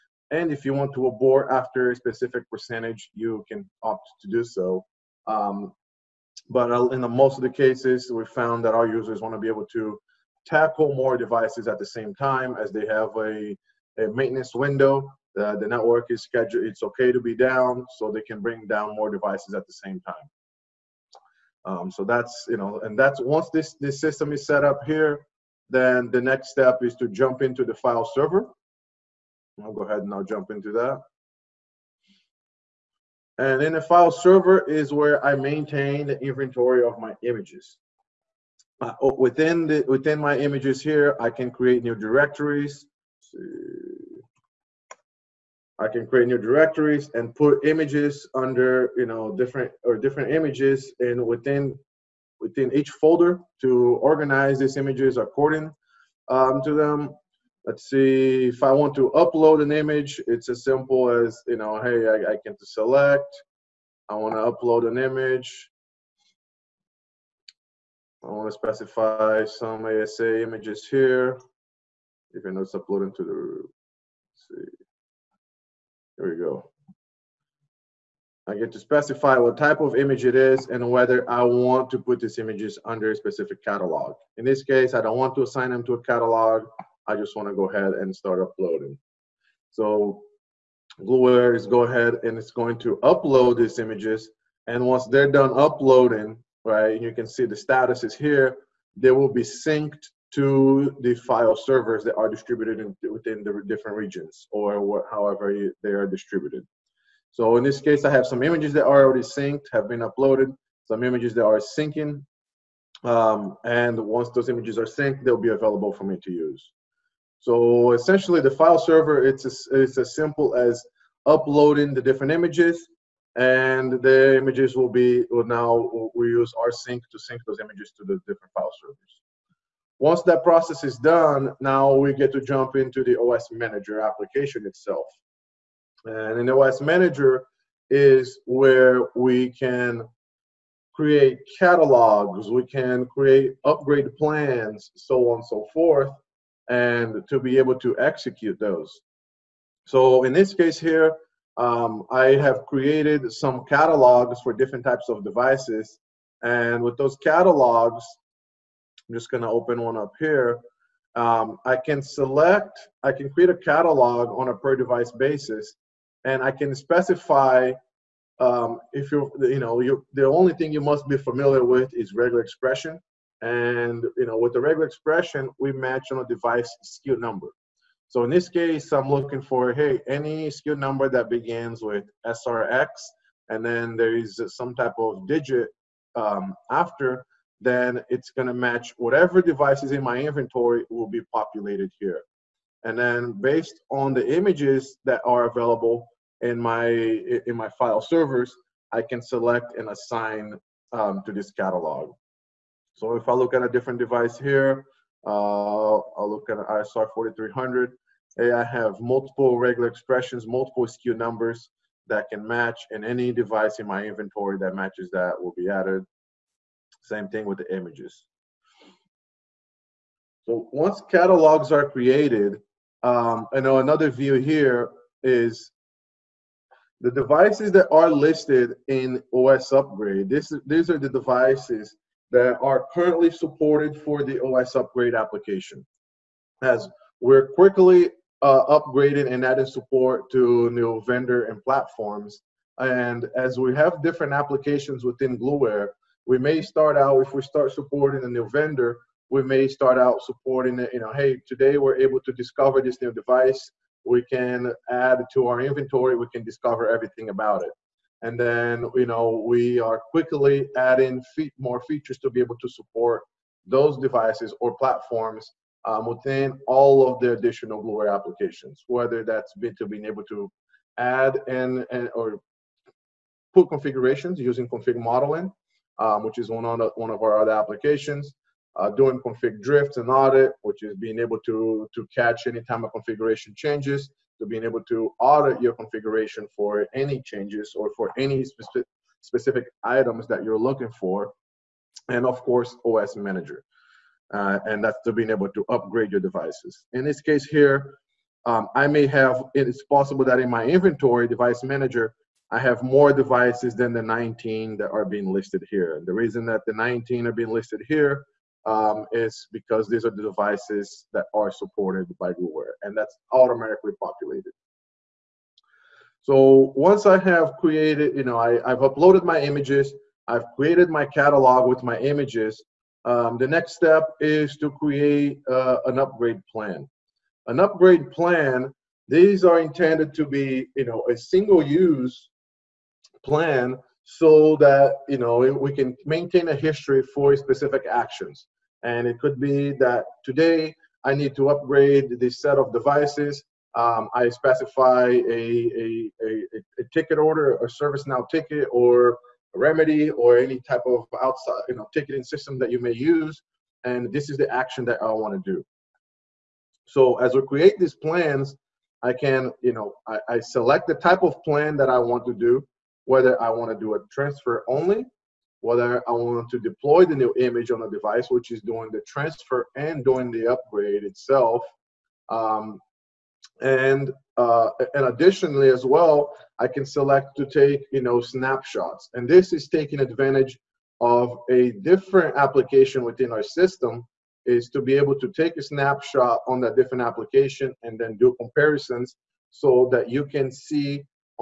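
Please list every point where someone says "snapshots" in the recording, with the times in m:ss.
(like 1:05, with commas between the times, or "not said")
6:18, 6:25.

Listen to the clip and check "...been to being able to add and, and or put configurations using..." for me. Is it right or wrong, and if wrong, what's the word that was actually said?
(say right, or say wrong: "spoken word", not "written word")
right.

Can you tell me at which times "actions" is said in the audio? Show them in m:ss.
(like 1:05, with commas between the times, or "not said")
5:37, 5:54.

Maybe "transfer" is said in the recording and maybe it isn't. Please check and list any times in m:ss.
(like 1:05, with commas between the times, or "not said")
6:04, 6:09.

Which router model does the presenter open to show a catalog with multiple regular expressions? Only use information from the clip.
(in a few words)
ISR 4300.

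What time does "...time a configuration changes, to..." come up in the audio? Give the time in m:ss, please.
4:42.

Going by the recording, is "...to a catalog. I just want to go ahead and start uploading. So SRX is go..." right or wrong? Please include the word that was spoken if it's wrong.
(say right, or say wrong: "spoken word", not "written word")
wrong: "Gluware", not "SRX".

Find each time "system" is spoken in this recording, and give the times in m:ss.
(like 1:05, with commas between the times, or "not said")
0:24, 5:52, 6:23.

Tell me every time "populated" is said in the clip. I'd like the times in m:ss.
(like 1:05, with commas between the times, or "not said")
3:11, 5:14.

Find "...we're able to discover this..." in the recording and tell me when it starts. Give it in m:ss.
4:11.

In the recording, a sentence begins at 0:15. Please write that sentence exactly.
the network is scheduled, it's okay to be down, so they can bring down more devices at the same time.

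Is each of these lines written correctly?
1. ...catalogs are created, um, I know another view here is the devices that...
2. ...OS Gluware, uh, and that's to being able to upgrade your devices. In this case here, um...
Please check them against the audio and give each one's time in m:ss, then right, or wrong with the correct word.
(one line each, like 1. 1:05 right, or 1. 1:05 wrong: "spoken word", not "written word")
1. 3:41 right
2. 4:52 wrong: "Manager", not "Gluware".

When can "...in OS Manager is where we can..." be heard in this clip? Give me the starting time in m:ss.
2:16.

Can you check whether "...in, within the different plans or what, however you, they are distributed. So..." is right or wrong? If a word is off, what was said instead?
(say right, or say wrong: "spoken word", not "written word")
wrong: "regions", not "plans".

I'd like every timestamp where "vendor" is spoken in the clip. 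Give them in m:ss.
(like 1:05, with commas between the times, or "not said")
4:01, 4:08.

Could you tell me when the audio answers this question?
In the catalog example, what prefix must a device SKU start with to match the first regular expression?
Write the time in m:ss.
3:02.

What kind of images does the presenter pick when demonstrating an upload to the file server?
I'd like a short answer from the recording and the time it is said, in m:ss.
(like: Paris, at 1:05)
ASA images, at 1:09.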